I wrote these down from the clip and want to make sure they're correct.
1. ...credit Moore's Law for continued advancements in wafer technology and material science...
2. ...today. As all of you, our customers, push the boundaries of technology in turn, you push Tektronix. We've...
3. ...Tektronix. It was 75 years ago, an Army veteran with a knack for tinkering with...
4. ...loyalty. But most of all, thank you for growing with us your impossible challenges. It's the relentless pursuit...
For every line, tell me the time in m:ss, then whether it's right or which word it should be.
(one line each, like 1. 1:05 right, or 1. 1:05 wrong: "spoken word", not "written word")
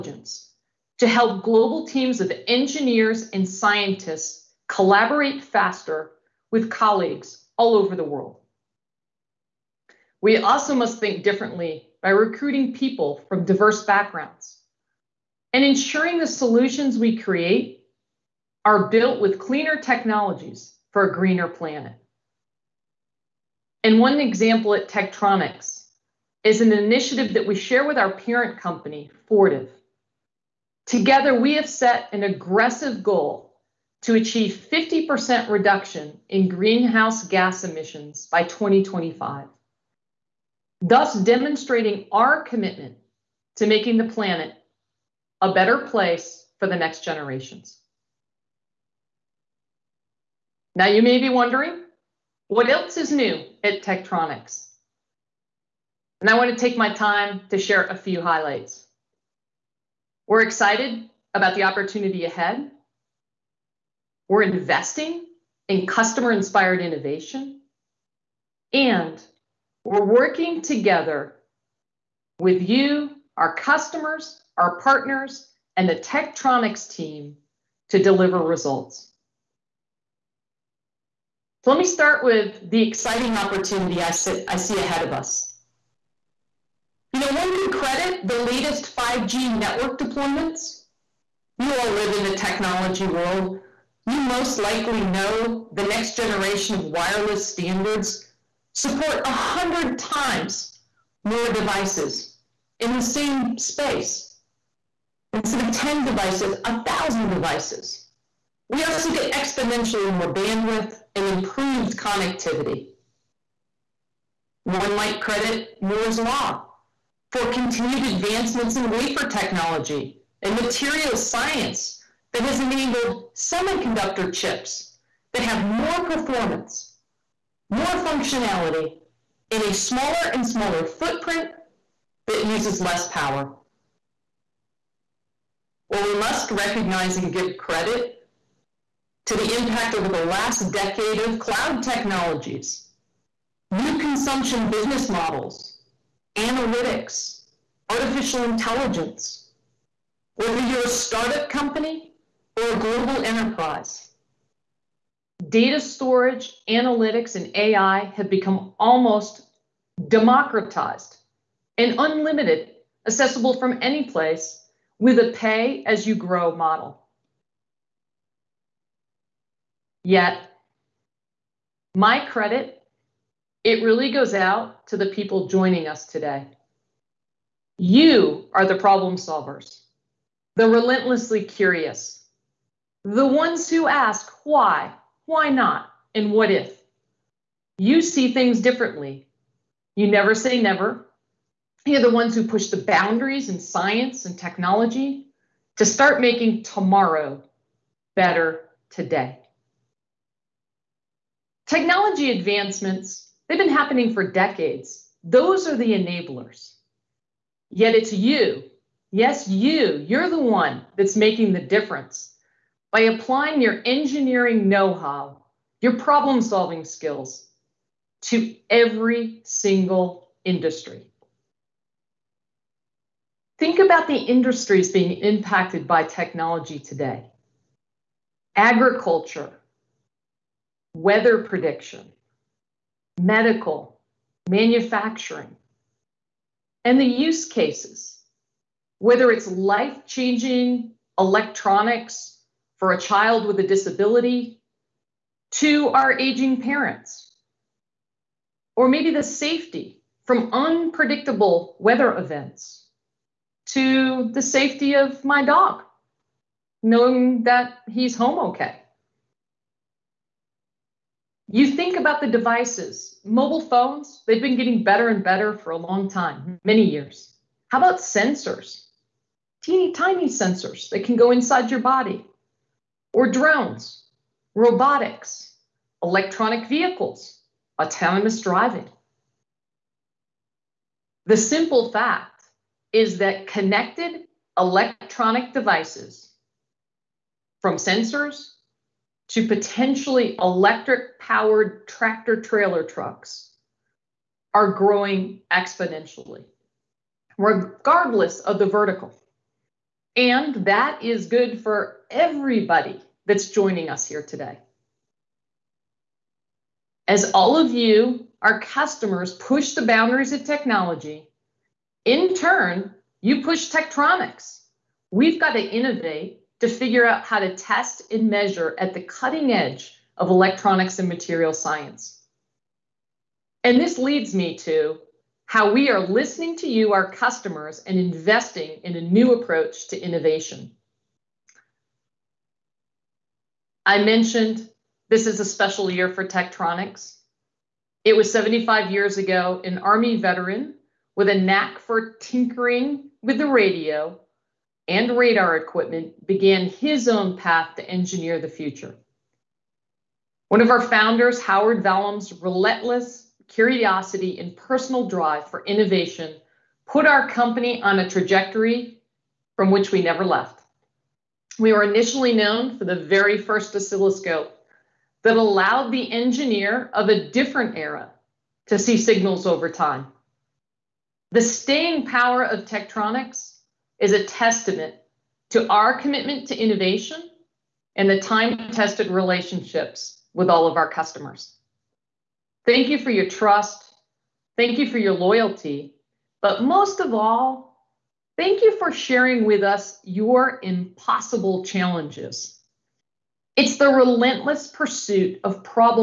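1. 1:55 right
2. 5:04 right
3. 5:36 right
4. 6:25 wrong: "sharing", not "growing".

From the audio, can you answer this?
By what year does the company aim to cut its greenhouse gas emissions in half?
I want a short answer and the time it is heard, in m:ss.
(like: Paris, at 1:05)
2025, at 0:38.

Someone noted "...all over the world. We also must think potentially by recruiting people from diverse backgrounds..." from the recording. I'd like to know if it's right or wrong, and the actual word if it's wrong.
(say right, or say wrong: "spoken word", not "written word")
wrong: "differently", not "potentially".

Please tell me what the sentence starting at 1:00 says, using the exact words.
We're excited about the opportunity ahead.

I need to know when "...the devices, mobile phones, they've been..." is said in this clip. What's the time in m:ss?
4:22.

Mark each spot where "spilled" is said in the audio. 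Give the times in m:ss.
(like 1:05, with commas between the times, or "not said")
not said.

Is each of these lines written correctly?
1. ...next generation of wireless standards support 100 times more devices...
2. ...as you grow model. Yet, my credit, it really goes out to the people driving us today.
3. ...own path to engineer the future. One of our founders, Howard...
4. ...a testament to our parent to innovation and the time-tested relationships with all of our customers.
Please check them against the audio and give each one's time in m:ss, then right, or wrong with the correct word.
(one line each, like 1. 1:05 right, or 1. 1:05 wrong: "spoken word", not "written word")
1. 1:35 right
2. 2:45 wrong: "joining", not "driving"
3. 5:47 right
4. 6:14 wrong: "commitment", not "parent".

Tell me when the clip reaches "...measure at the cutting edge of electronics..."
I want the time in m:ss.
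5:18.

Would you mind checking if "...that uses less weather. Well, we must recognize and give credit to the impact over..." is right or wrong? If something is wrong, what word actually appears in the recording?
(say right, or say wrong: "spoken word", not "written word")
wrong: "power", not "weather".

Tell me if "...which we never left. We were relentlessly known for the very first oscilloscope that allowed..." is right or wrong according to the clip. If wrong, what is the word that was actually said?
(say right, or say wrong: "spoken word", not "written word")
wrong: "initially", not "relentlessly".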